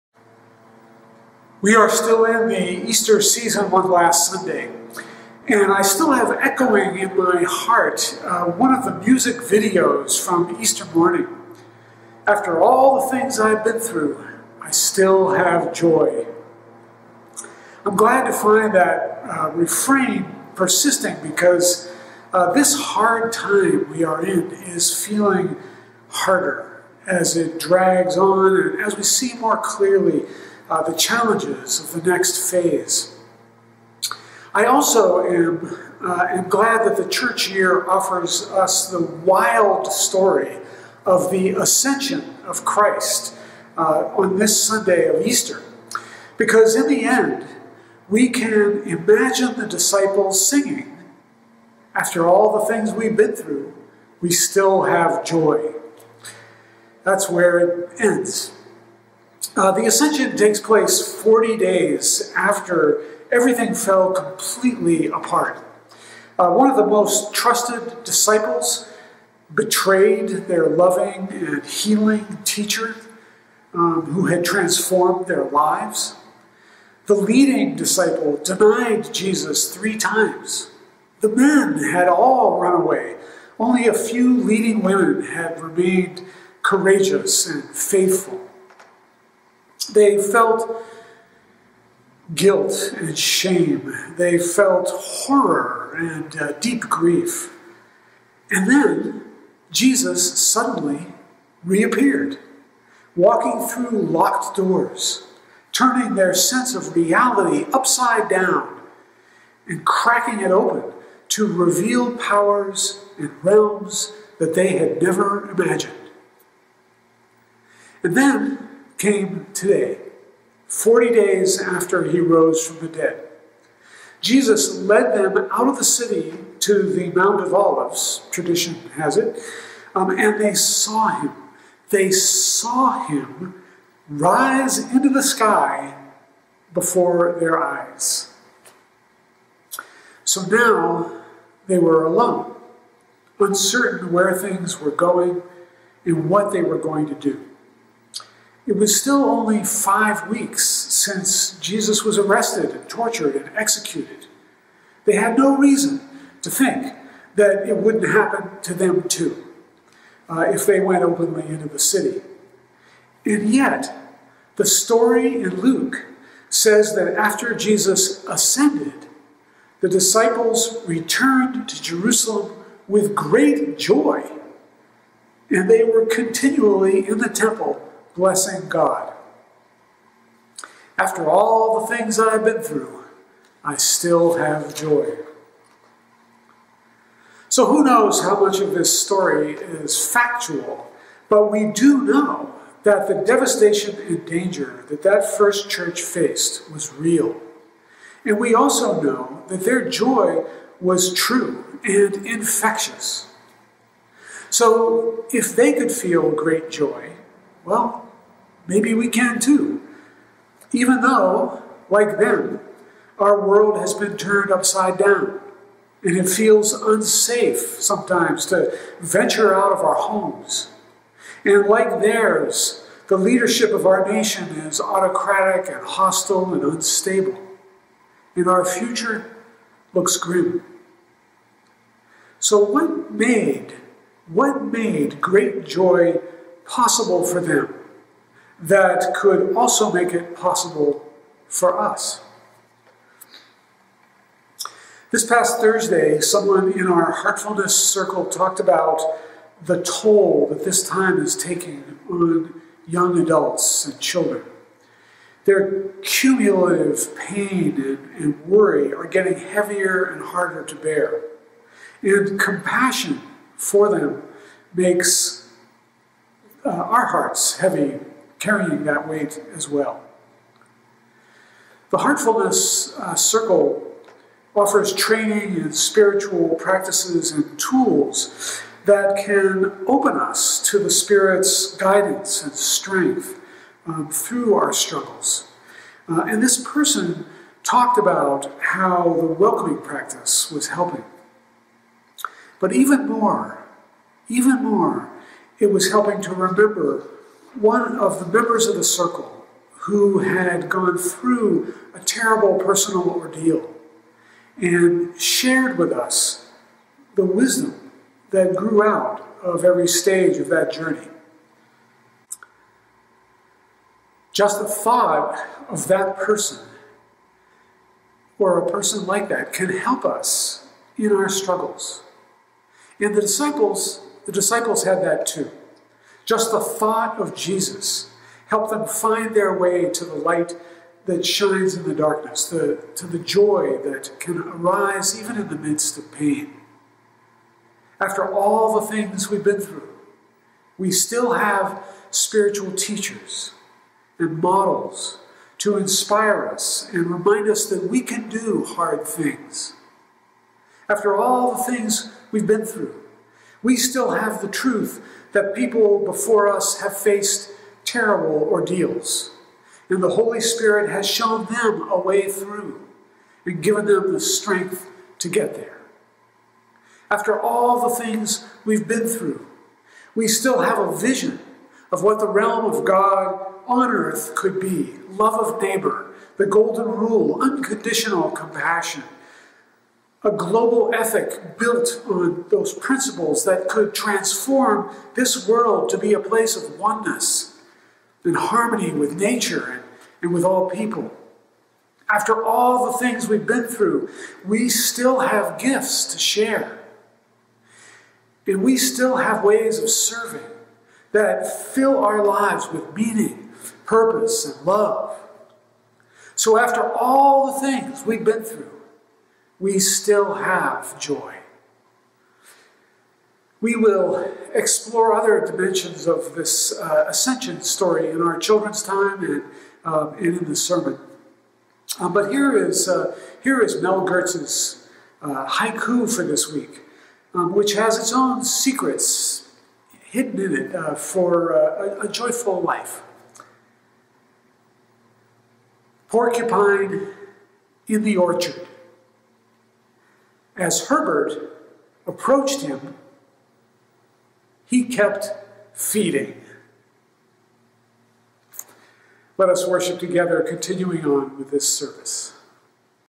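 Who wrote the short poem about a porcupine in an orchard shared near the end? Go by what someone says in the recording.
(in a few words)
Mel Goertz.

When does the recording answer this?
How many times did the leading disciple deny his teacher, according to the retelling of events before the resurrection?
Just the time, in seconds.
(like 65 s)
79 s.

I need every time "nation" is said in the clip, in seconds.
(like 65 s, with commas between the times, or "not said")
224 s.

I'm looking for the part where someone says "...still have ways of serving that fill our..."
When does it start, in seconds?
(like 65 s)
398 s.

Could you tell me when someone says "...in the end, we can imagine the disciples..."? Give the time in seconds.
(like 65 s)
46 s.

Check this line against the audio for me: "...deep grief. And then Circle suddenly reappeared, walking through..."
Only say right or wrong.
wrong.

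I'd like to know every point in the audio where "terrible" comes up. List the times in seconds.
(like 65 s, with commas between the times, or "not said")
301 s, 357 s.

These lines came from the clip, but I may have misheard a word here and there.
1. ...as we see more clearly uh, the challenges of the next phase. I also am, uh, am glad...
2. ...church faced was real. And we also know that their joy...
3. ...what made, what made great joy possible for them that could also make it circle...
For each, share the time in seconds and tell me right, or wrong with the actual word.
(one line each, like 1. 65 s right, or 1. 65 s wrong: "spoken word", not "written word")
1. 28 s right
2. 195 s right
3. 232 s wrong: "possible", not "circle".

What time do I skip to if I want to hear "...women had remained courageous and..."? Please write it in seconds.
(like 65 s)
84 s.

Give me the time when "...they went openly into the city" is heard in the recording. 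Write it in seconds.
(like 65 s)
160 s.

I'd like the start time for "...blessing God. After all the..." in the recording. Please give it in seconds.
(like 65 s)
178 s.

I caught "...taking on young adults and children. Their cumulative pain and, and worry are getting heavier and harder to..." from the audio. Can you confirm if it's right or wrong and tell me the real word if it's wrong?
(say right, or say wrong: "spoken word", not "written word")
right.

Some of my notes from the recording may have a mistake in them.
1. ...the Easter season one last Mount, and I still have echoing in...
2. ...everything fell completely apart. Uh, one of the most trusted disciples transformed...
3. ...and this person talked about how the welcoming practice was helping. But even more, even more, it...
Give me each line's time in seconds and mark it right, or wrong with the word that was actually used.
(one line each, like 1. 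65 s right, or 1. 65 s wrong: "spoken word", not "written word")
1. 2 s wrong: "Sunday", not "Mount"
2. 63 s wrong: "betrayed", not "transformed"
3. 286 s right.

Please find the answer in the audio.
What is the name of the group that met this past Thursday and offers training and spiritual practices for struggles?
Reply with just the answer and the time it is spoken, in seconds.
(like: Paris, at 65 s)
Heartfulness Circle, at 247 s.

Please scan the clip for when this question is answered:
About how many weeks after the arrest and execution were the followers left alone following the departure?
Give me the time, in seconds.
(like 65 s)
149 s.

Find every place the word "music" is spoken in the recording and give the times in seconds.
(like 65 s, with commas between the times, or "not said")
9 s.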